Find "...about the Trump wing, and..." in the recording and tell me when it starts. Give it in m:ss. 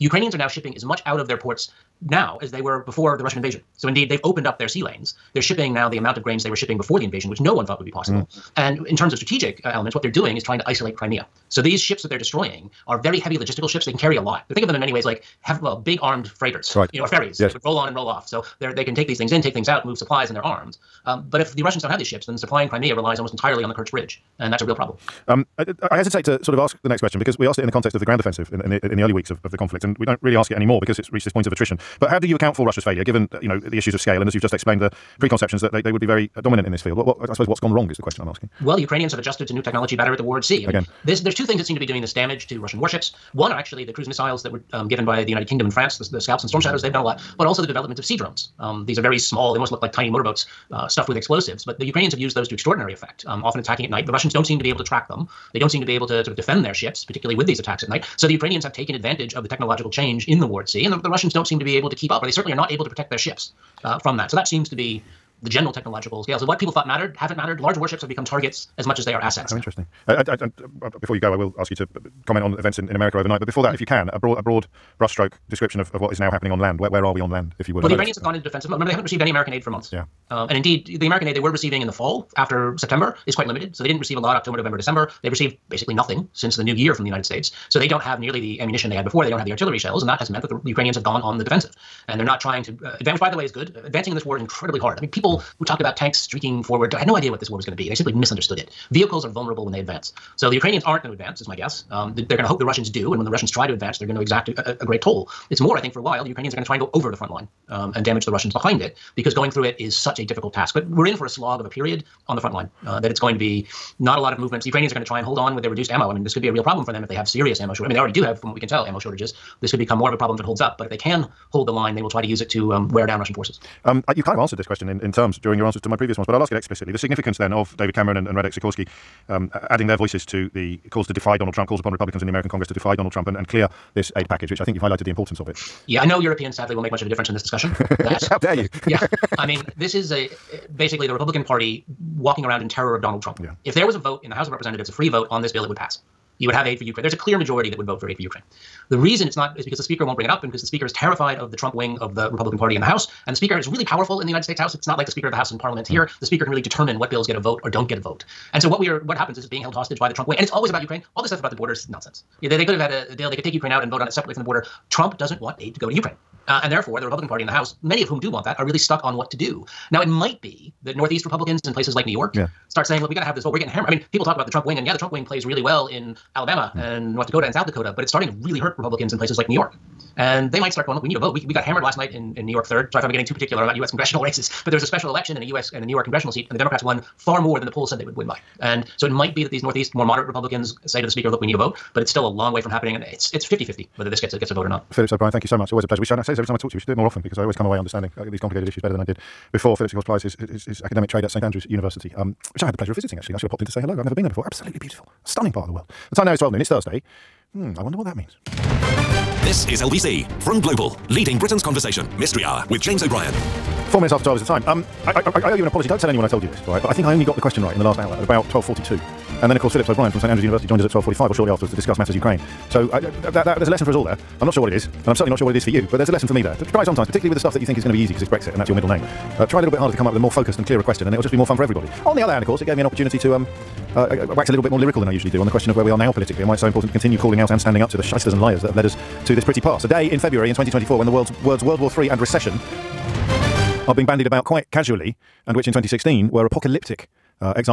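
2:54.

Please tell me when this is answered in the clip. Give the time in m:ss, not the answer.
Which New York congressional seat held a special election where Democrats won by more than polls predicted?
3:02.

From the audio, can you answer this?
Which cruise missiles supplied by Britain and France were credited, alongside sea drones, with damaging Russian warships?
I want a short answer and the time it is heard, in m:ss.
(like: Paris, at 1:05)
Scalps and Storm Shadows, at 0:46.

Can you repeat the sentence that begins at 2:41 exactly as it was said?
All this stuff about the borders nonsense.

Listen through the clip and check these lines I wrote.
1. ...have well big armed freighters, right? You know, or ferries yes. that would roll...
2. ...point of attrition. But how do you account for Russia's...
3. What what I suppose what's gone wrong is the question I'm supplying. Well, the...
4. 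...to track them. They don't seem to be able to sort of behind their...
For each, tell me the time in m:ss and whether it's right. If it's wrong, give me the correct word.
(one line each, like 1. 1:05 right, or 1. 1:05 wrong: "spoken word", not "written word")
1. 0:15 right
2. 0:31 right
3. 0:36 wrong: "asking", not "supplying"
4. 0:54 wrong: "defend", not "behind".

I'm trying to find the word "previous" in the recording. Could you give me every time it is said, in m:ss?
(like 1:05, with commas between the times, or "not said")
2:05.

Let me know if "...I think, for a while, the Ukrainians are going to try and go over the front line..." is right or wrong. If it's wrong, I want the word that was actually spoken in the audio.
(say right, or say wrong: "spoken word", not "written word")
right.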